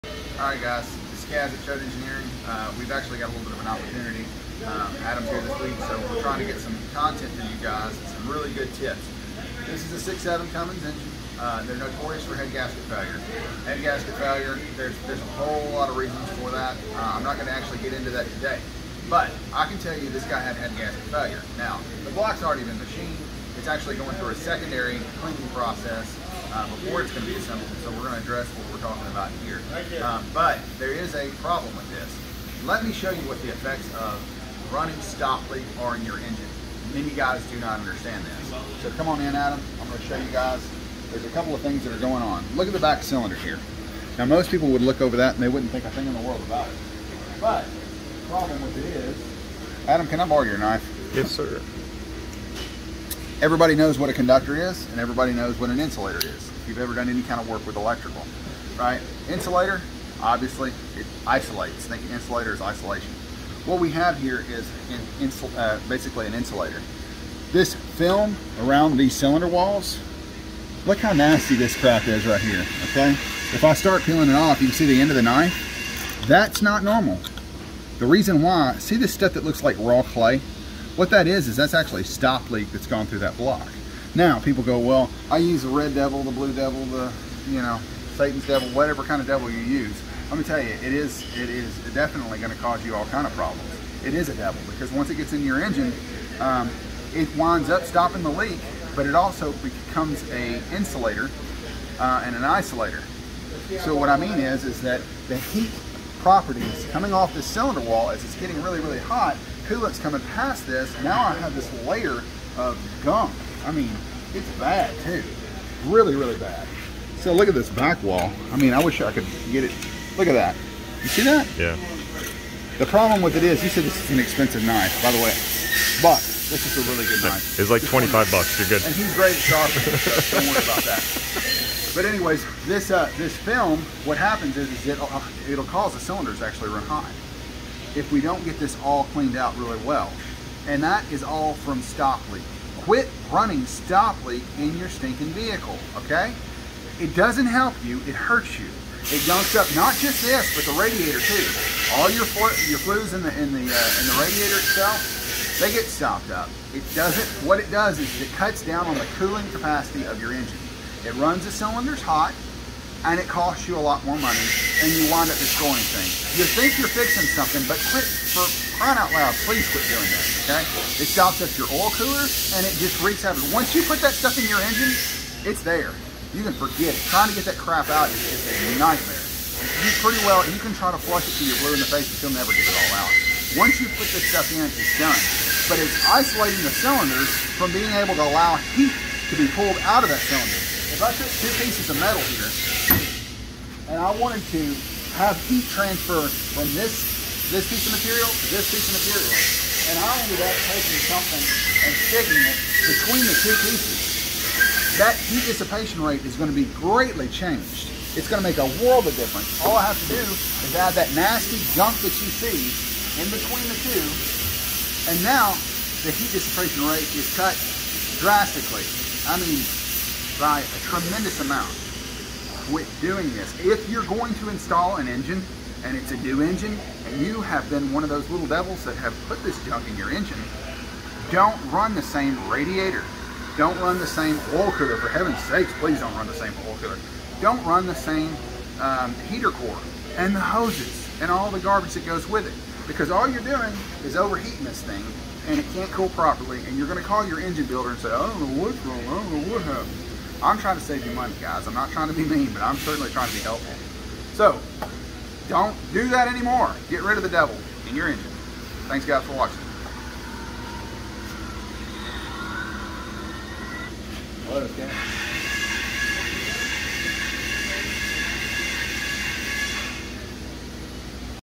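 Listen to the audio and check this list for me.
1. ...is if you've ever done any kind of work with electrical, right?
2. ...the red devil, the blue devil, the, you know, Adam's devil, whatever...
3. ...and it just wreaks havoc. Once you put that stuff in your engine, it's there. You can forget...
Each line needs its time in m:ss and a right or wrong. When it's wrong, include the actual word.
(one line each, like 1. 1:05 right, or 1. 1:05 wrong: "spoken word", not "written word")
1. 0:56 right
2. 1:25 wrong: "Satan", not "Adam"
3. 2:52 right.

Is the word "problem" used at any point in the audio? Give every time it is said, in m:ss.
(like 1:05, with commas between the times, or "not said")
0:31, 0:48, 1:33, 2:02.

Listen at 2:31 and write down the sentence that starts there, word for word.
All your your flues in the in the uh, in the radiator itself, they get stopped up.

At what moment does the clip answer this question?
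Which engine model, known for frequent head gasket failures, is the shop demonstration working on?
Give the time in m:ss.
0:10.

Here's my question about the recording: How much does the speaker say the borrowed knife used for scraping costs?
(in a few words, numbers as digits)
$25.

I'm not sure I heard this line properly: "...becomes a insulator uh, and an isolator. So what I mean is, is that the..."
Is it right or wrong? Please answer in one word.
right.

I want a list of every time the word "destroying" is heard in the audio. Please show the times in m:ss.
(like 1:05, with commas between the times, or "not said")
2:45.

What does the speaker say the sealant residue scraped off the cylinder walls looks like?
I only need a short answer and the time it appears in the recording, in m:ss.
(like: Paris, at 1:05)
Raw clay, at 1:19.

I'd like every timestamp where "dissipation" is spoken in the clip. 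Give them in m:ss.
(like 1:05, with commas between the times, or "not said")
3:25, 3:36.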